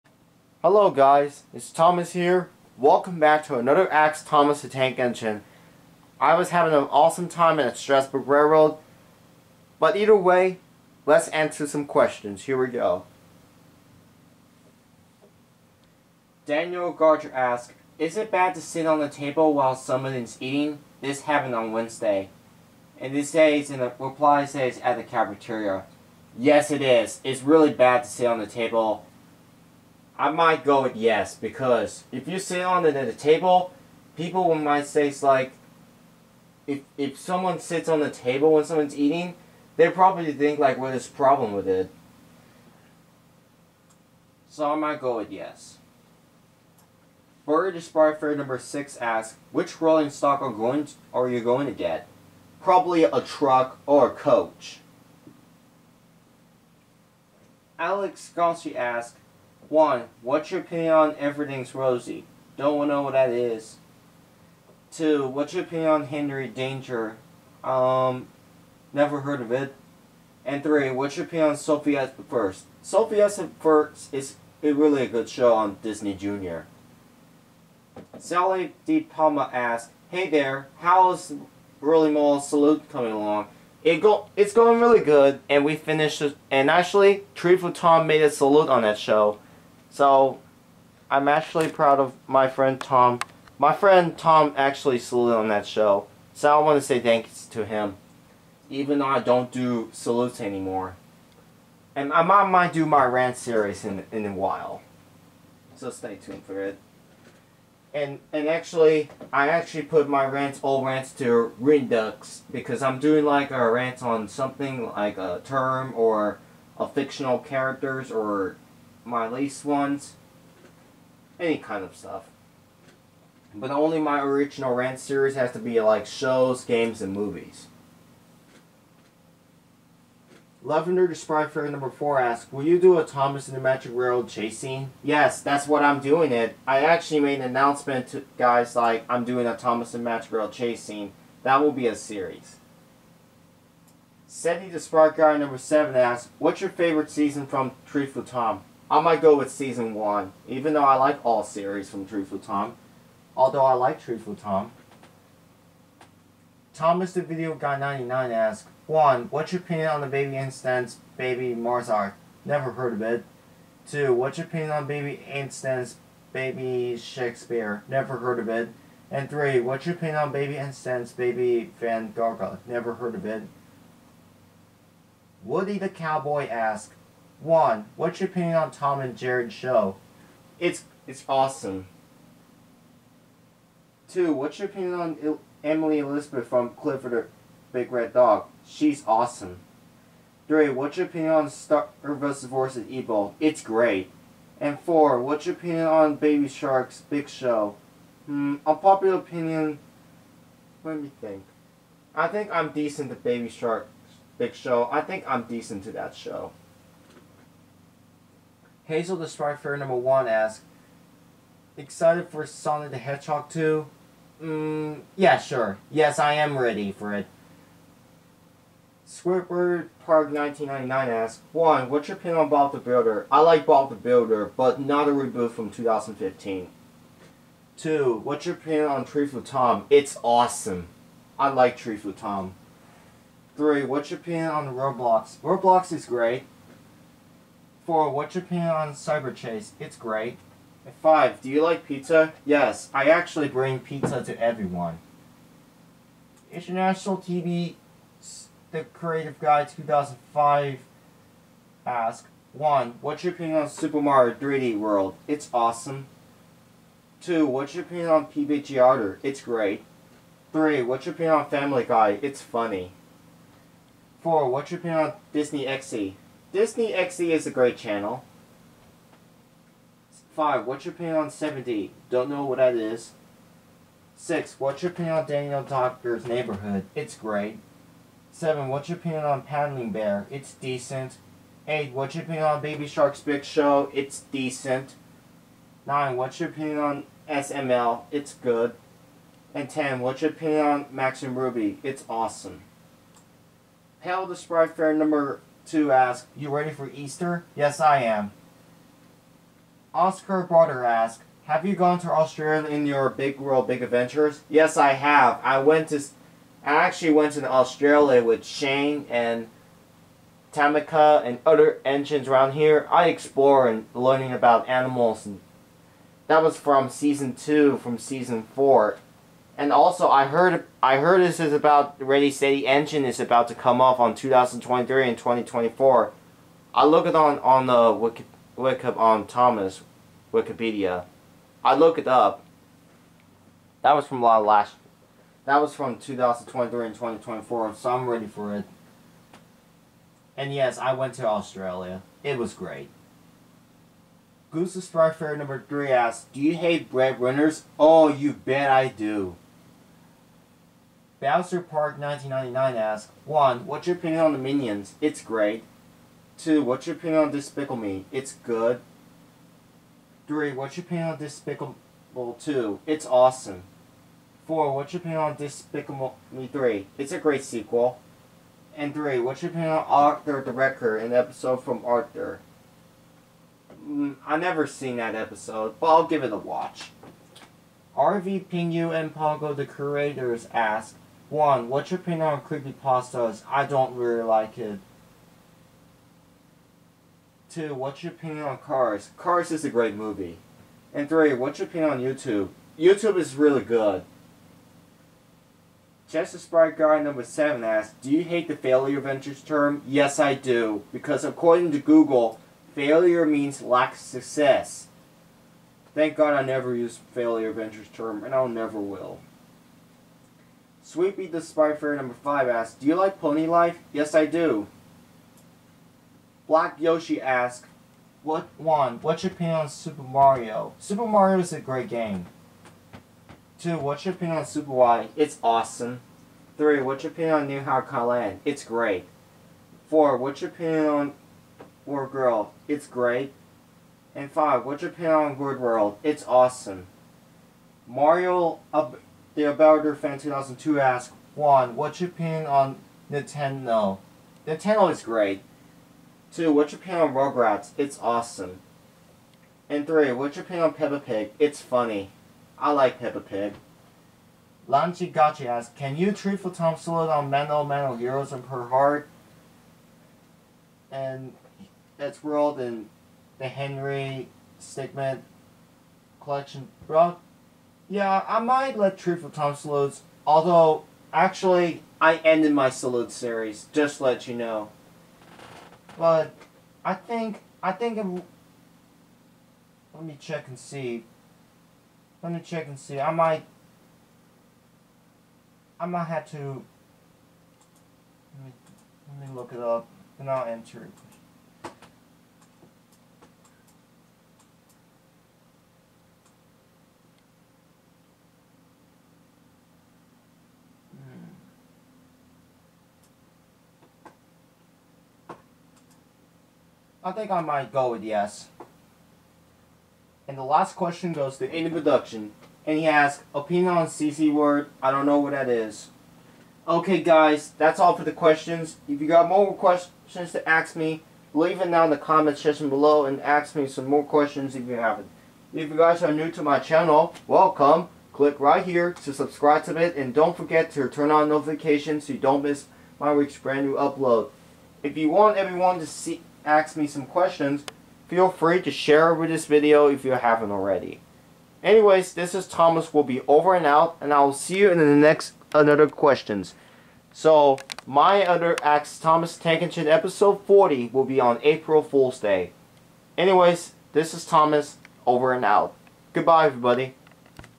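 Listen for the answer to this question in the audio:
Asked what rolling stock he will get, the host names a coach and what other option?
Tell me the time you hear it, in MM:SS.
00:53.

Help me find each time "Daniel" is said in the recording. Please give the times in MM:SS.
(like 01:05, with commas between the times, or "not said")
00:16, 04:35.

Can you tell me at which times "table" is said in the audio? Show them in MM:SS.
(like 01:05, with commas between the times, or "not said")
00:19, 00:28, 00:33, 00:38.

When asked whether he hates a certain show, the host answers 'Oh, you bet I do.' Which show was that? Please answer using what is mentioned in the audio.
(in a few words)
Breadwinners.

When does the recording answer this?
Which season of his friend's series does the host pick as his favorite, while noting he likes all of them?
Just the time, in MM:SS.
02:29.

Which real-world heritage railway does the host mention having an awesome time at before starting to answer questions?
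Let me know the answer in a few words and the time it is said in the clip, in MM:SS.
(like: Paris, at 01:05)
Strasburg Railroad, at 00:07.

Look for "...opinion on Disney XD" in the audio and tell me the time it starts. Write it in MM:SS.
04:24.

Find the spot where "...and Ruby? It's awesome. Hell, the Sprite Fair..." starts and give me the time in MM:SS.
04:51.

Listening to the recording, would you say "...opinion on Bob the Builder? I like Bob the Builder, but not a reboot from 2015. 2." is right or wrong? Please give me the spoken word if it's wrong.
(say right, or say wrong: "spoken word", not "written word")
right.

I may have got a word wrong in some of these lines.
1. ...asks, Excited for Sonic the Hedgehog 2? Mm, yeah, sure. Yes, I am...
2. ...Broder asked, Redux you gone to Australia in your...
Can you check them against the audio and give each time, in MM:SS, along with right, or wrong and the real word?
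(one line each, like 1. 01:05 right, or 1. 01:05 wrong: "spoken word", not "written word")
1. 03:30 right
2. 05:00 wrong: "Have", not "Redux".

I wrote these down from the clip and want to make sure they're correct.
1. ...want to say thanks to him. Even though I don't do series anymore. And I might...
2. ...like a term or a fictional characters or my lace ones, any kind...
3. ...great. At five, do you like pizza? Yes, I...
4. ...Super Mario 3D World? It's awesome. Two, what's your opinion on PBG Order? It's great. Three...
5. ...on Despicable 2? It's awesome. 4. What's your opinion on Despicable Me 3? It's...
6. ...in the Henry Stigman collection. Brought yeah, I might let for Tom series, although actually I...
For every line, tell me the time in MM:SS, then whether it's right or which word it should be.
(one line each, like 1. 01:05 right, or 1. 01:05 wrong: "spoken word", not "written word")
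1. 01:36 wrong: "salutes", not "series"
2. 01:54 right
3. 03:59 right
4. 04:13 right
5. 06:01 right
6. 07:42 wrong: "salutes", not "series".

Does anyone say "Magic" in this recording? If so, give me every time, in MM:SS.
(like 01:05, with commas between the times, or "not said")
02:13, 02:20.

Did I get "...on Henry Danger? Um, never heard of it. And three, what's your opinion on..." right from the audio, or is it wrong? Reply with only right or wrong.
right.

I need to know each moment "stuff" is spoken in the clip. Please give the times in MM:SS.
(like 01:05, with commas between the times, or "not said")
02:01.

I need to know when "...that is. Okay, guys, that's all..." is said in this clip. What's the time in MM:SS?
08:35.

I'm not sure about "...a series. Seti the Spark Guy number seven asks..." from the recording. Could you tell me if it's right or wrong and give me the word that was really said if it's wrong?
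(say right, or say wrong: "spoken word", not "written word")
right.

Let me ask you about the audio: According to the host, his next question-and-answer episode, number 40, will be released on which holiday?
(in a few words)
April Fool's Day.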